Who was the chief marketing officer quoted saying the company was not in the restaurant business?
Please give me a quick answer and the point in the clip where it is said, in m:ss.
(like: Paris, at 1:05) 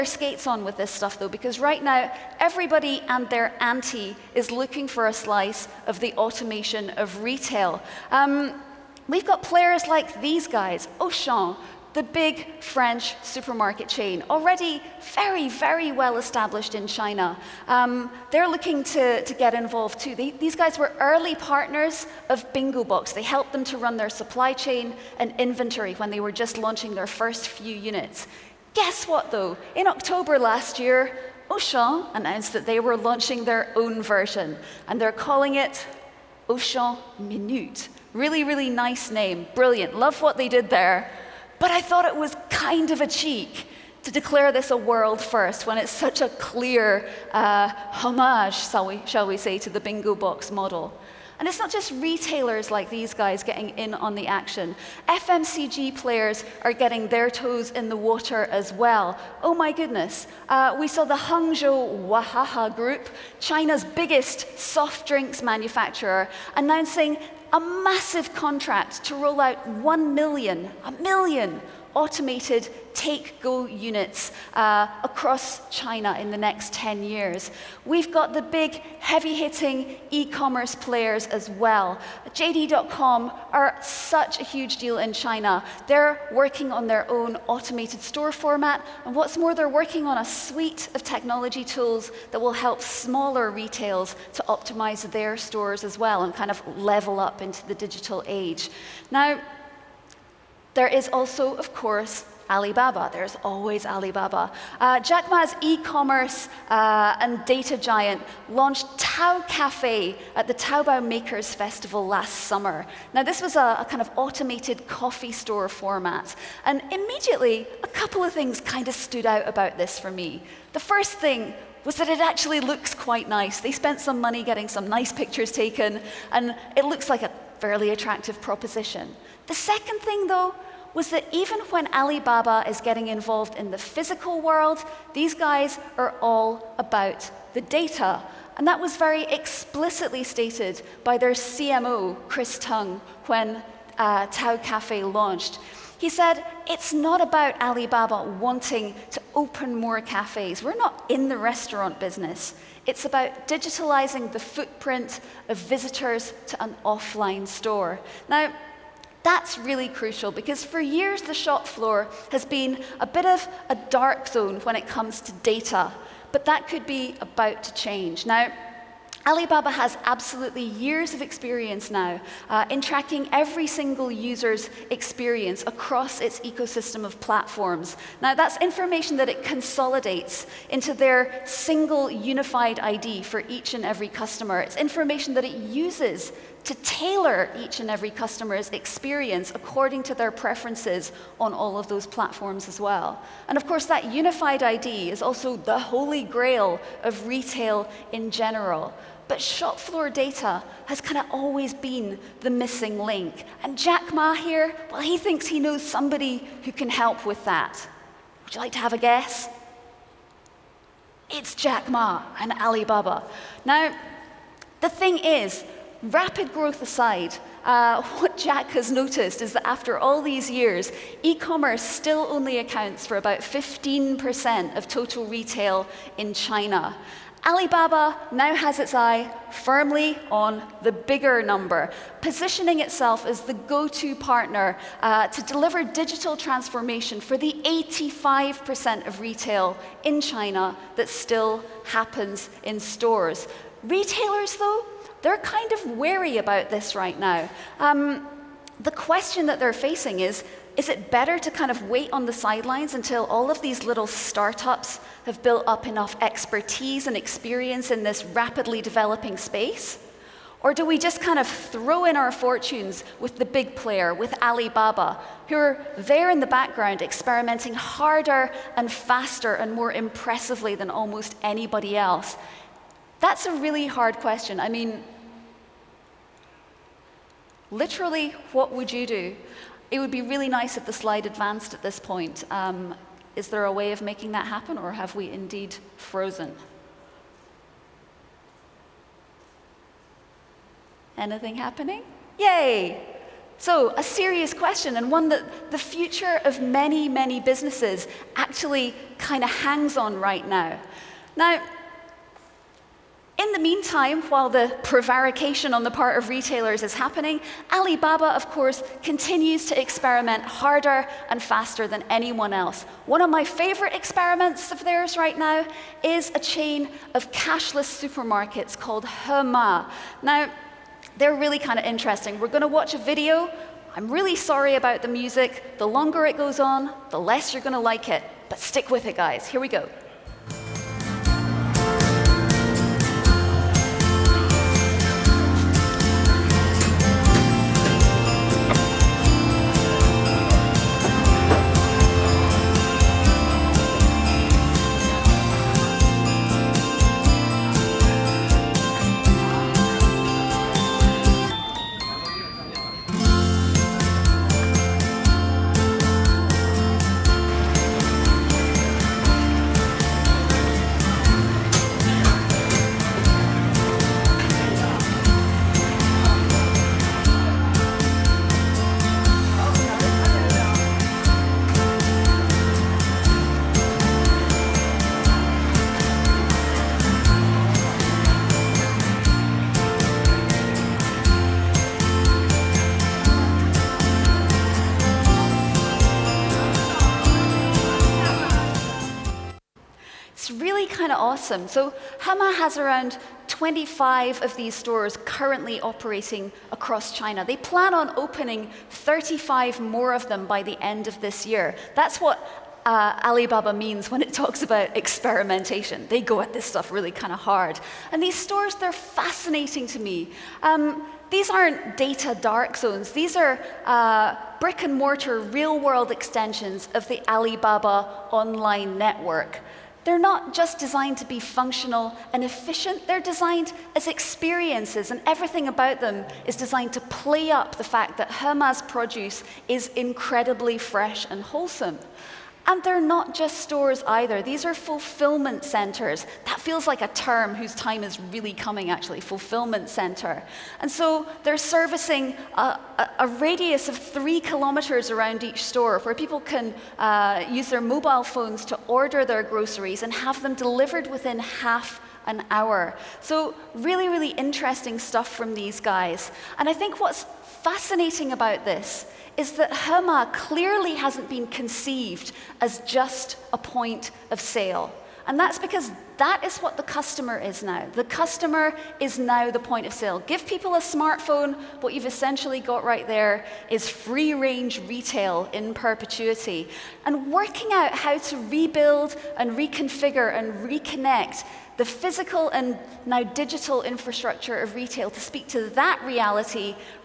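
Chris Tung, at 2:22.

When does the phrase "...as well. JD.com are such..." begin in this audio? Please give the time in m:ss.
1:21.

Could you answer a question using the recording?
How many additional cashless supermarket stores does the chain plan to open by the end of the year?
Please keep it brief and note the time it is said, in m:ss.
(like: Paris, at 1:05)
35, at 6:38.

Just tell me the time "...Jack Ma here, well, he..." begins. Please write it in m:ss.
3:23.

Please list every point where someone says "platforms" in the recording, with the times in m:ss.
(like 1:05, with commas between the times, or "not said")
2:57, 3:12.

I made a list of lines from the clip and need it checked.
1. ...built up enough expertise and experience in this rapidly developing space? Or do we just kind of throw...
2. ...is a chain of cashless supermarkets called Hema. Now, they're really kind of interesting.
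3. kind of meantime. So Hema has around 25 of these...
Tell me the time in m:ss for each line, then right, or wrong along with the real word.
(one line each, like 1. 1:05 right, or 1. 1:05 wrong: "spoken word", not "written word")
1. 4:15 right
2. 5:16 right
3. 6:31 wrong: "awesome", not "meantime".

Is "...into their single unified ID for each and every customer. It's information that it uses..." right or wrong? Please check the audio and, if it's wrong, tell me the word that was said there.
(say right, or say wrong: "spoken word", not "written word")
right.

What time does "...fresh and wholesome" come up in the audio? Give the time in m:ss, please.
7:10.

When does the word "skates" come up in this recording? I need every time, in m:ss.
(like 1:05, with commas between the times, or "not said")
0:00.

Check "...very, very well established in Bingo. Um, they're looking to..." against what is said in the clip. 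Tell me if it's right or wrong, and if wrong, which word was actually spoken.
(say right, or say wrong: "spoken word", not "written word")
wrong: "China", not "Bingo".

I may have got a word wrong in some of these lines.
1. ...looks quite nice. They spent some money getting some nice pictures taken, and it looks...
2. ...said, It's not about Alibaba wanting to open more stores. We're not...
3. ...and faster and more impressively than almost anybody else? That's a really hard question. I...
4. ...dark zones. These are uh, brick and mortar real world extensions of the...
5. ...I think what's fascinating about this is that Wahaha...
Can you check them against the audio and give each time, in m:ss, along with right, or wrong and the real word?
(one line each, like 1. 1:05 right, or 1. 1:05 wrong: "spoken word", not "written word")
1. 2:02 right
2. 2:26 wrong: "cafes", not "stores"
3. 4:28 right
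4. 6:52 right
5. 7:36 wrong: "Hema", not "Wahaha".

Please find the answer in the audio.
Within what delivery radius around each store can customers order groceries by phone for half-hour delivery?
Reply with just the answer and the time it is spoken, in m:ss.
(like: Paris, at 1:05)
3 kilometers, at 7:23.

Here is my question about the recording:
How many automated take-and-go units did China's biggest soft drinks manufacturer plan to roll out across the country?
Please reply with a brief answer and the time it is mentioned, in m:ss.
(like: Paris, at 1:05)
1 million, at 1:09.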